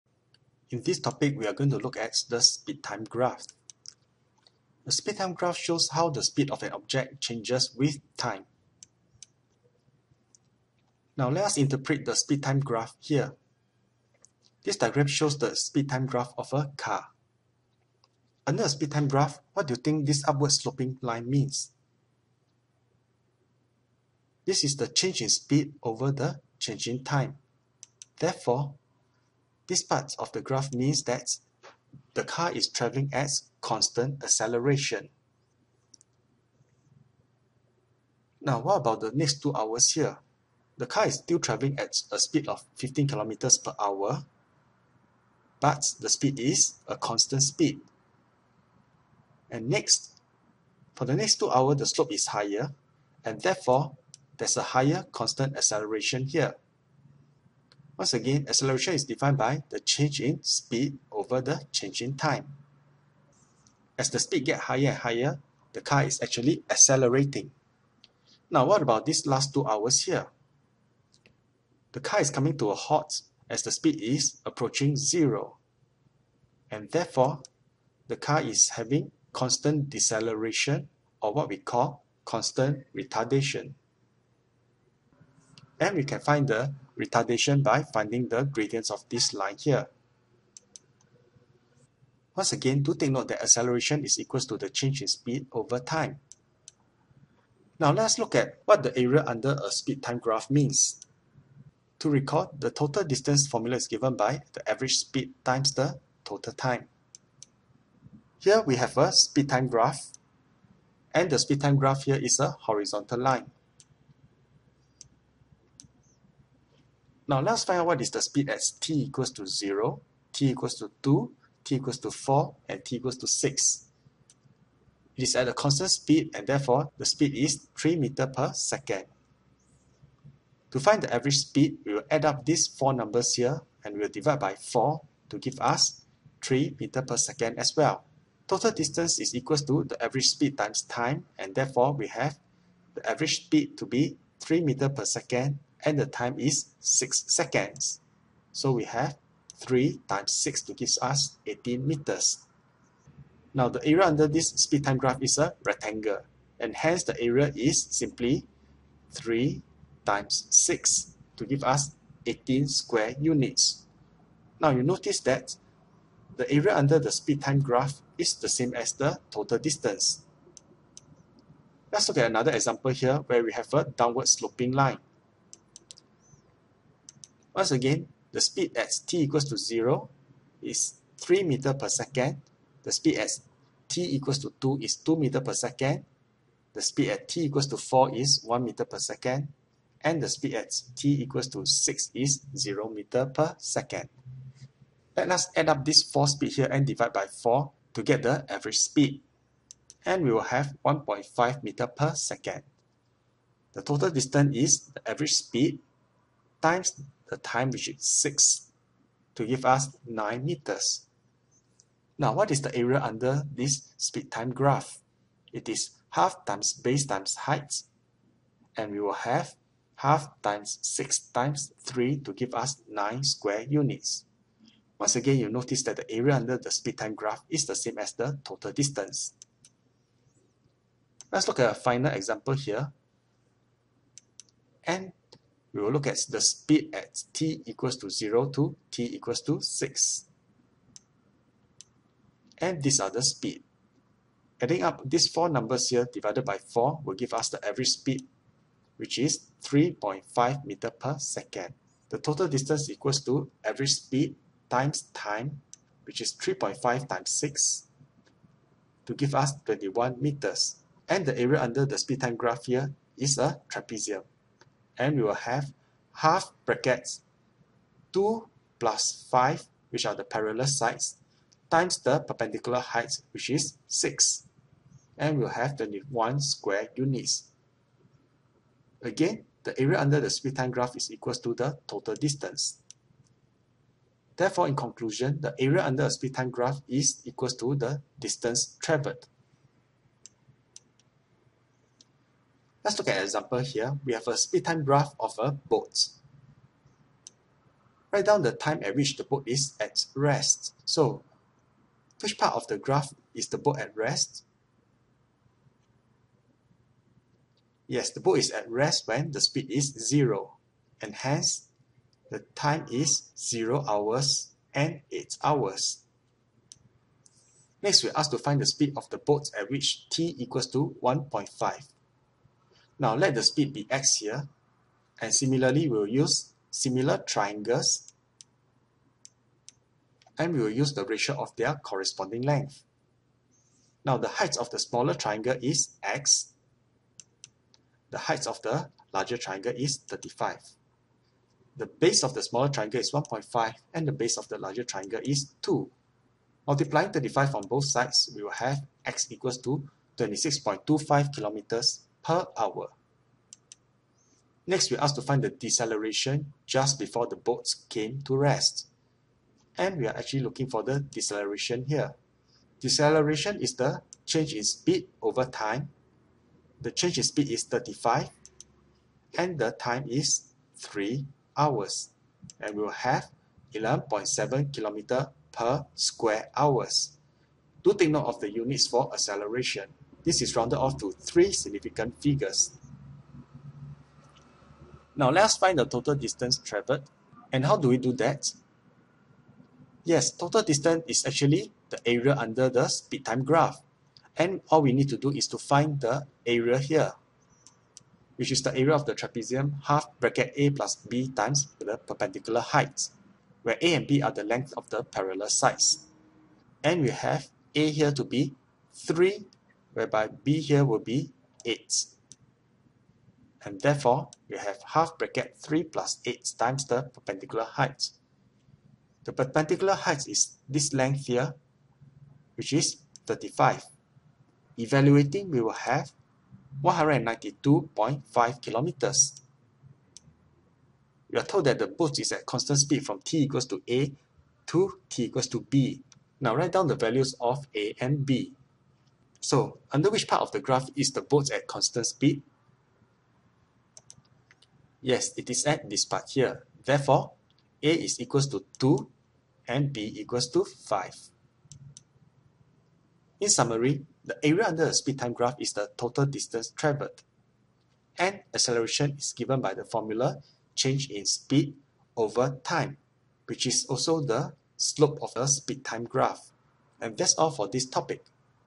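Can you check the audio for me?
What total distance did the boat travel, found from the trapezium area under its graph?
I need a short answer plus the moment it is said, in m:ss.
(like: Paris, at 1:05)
192.5 km, at 7:06.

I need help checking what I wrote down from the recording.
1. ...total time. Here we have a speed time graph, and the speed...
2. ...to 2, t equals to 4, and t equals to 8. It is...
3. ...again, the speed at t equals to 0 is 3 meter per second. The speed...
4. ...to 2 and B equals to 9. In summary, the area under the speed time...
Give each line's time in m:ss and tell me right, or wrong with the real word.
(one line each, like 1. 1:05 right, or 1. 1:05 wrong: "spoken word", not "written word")
1. 1:46 right
2. 2:00 wrong: "6", not "8"
3. 2:57 right
4. 7:28 wrong: "5", not "9".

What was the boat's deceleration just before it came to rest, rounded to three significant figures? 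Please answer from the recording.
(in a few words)
11.7 km/h².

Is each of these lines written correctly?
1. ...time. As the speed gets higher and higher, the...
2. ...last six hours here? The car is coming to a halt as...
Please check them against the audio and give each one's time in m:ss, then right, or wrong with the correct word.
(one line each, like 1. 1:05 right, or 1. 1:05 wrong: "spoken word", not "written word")
1. 1:02 right
2. 1:09 wrong: "two", not "six".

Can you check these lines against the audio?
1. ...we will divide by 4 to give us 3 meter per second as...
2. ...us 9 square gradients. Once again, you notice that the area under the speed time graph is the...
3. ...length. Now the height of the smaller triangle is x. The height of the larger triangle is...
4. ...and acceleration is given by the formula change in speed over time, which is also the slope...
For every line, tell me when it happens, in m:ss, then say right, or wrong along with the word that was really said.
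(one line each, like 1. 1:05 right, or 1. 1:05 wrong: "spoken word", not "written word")
1. 2:13 right
2. 3:42 wrong: "units", not "gradients"
3. 5:32 right
4. 7:38 right.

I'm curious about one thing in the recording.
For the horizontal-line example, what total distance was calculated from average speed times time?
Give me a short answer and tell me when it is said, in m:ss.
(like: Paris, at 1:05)
18 meters, at 2:31.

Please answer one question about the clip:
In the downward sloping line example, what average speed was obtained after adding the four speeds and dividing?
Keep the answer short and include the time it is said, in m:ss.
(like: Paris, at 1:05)
1.5 m/s, at 3:20.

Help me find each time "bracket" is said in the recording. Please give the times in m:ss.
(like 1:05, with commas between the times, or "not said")
4:26, 6:40, 6:55.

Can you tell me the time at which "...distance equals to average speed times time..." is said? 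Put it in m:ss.
4:12.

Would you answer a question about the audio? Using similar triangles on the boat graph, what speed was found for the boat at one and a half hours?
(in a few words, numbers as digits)
26.25 km/h.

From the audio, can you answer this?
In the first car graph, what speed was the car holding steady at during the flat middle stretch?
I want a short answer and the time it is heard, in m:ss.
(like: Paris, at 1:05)
15 km/h, at 0:42.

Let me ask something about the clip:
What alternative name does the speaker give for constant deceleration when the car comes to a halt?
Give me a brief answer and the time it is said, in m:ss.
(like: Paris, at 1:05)
constant retardation, at 1:22.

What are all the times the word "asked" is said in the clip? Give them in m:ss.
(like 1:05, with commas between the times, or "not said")
5:18, 5:55.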